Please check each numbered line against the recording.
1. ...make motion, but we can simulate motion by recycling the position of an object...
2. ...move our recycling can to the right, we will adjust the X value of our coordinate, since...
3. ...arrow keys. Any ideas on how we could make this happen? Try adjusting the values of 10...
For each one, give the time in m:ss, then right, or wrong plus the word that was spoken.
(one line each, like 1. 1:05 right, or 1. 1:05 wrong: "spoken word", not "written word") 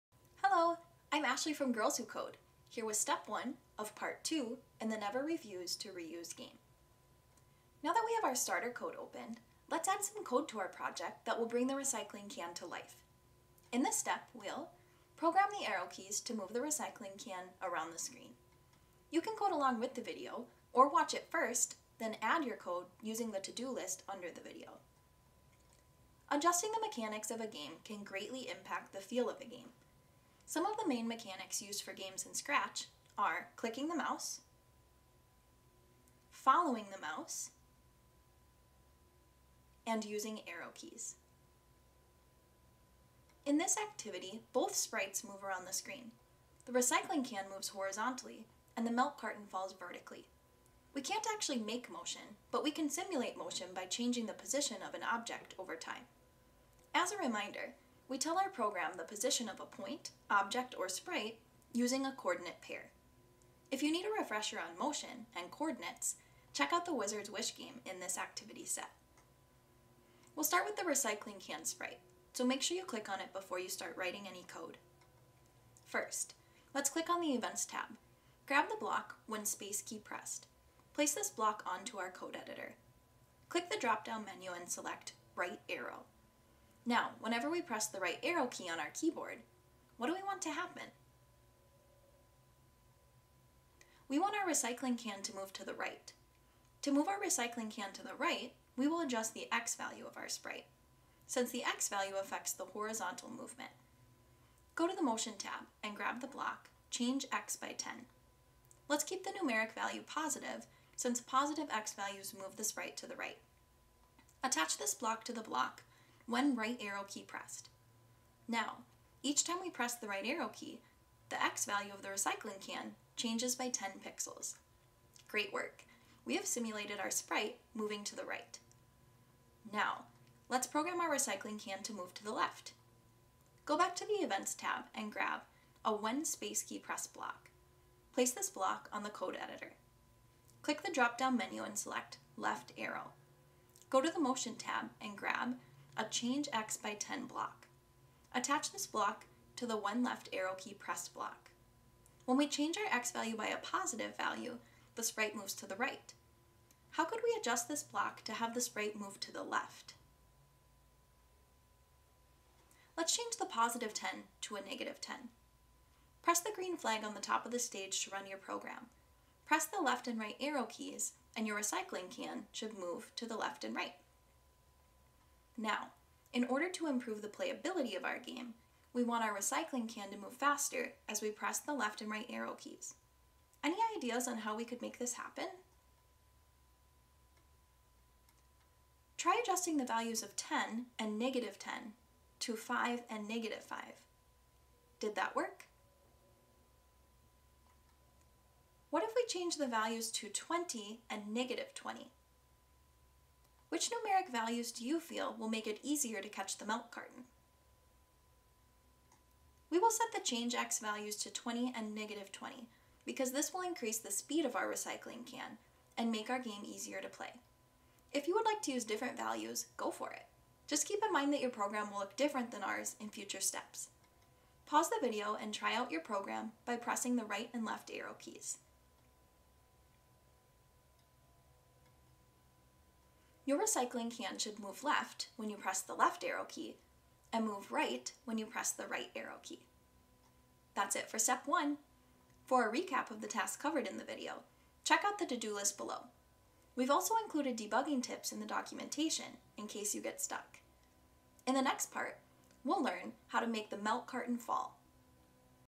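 1. 0:51 wrong: "changing", not "recycling"
2. 1:36 wrong: "sprite", not "coordinate"
3. 3:02 right.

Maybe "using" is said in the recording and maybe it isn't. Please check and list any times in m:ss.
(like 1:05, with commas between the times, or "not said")
0:23, 0:40, 1:01.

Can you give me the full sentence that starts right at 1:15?
First, let's click on the Events tab.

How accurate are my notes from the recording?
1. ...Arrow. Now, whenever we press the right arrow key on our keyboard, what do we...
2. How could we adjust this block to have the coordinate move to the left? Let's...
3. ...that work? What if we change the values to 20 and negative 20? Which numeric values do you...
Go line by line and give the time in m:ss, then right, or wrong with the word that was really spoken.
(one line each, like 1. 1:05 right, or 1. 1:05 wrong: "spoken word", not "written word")
1. 1:25 right
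2. 2:36 wrong: "sprite", not "coordinate"
3. 3:15 right.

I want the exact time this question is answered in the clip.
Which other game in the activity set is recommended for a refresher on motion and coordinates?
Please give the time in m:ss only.
1:06.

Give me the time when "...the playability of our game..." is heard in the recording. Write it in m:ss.
2:57.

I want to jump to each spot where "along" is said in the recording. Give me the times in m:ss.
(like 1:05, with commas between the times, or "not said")
0:19.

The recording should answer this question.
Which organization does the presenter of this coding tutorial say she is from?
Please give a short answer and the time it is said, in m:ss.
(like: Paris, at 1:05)
Girls Who Code, at 0:01.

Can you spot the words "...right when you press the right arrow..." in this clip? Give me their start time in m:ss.
3:57.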